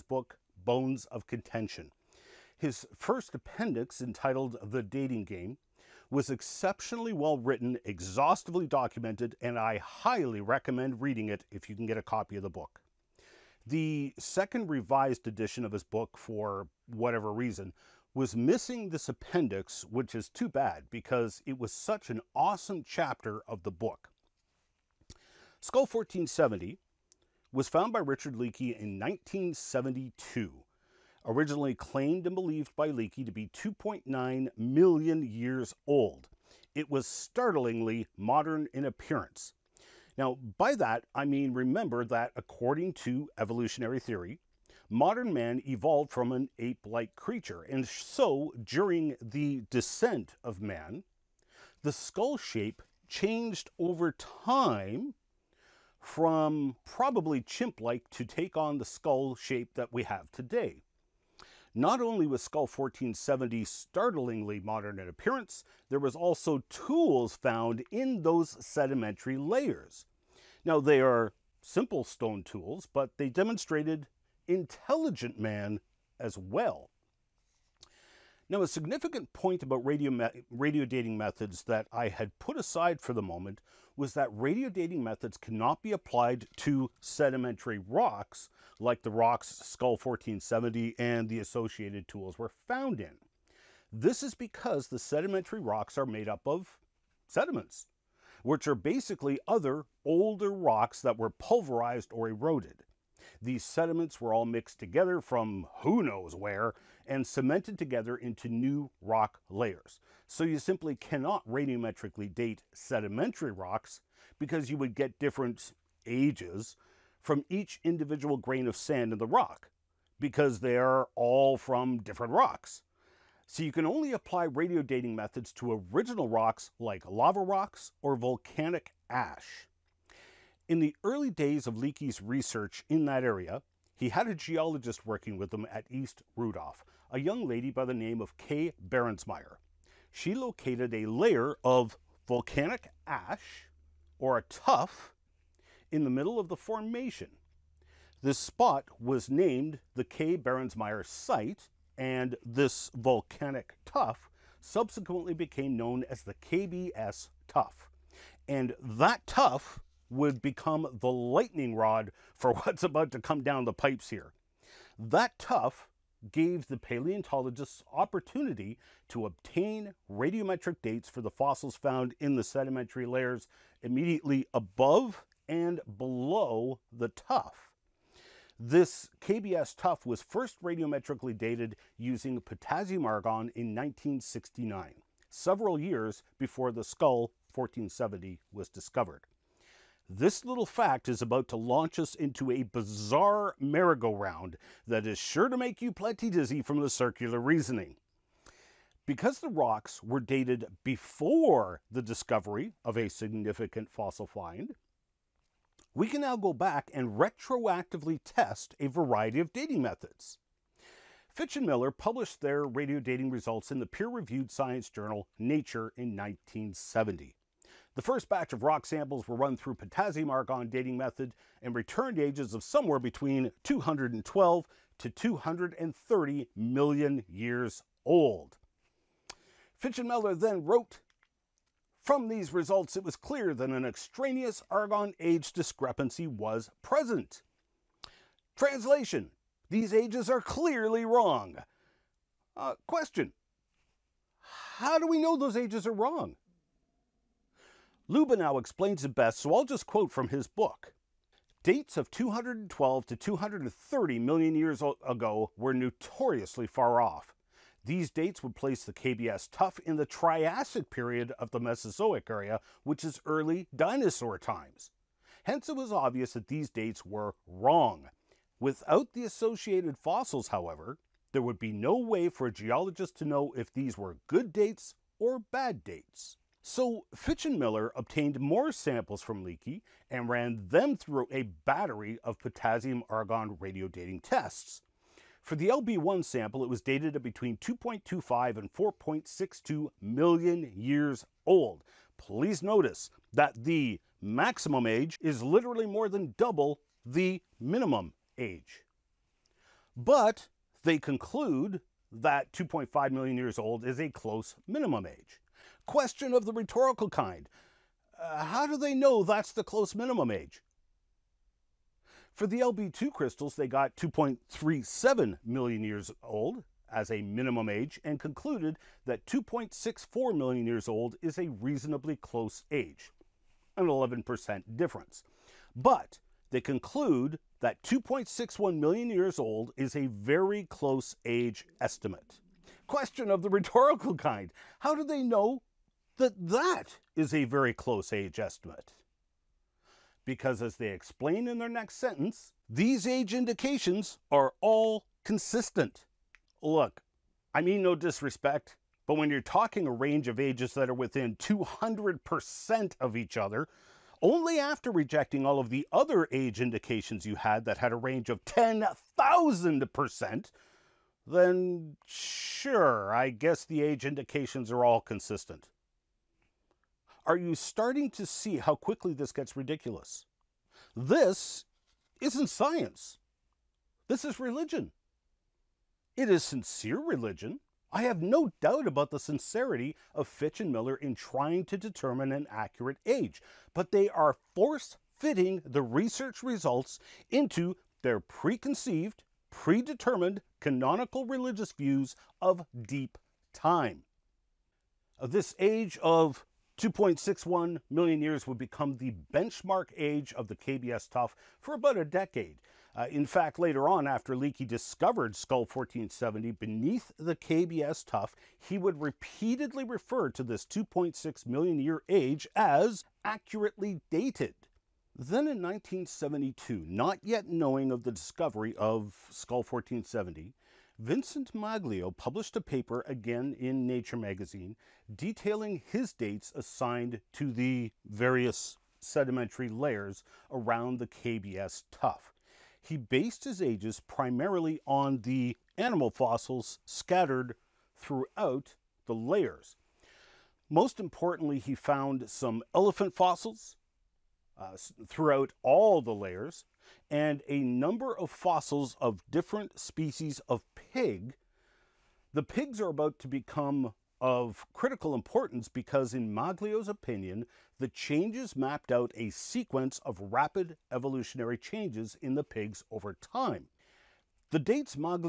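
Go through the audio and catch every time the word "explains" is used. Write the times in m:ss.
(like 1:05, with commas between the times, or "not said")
4:08, 5:40.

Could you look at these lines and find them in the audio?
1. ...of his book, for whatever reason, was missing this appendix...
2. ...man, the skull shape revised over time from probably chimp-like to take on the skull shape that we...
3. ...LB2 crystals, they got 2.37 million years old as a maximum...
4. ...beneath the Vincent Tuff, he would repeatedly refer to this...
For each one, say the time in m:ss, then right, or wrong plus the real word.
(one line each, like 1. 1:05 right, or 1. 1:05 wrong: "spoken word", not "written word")
1. 0:15 right
2. 0:50 wrong: "changed", not "revised"
3. 5:12 wrong: "minimum", not "maximum"
4. 6:46 wrong: "KBS", not "Vincent".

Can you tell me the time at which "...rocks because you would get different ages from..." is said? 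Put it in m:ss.
1:53.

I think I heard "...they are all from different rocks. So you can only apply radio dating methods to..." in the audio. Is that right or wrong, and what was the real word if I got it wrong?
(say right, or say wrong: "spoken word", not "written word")
right.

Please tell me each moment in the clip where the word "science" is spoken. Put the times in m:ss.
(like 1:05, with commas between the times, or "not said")
3:34, 6:12.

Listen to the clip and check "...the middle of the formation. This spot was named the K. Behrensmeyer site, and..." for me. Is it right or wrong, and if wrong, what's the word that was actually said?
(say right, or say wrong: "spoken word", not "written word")
right.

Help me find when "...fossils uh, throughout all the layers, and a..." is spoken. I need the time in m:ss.
7:23.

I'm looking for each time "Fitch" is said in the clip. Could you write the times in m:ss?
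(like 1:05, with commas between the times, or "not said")
3:31, 3:49, 4:37, 6:20.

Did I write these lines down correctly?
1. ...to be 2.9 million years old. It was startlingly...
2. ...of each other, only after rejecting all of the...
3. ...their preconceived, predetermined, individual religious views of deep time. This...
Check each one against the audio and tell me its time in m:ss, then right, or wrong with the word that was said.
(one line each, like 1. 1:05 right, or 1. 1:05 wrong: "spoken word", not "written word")
1. 0:33 right
2. 5:53 right
3. 6:28 wrong: "canonical", not "individual".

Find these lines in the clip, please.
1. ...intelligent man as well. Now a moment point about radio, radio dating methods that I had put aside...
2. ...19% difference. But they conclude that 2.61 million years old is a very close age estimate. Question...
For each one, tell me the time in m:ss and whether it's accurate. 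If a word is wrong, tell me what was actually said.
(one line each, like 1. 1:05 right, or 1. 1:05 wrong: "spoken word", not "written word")
1. 1:14 wrong: "significant", not "moment"
2. 5:23 wrong: "11", not "19".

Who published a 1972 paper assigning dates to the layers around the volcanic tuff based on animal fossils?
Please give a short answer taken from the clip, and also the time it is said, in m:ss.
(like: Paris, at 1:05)
Vincent Maglio, at 7:00.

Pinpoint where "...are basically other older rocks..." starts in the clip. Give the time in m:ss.
1:38.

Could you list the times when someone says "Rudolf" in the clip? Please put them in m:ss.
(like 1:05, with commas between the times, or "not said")
2:16.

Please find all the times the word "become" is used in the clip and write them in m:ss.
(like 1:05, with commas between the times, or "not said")
2:40, 6:38, 7:33.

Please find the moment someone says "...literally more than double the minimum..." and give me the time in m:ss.
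4:55.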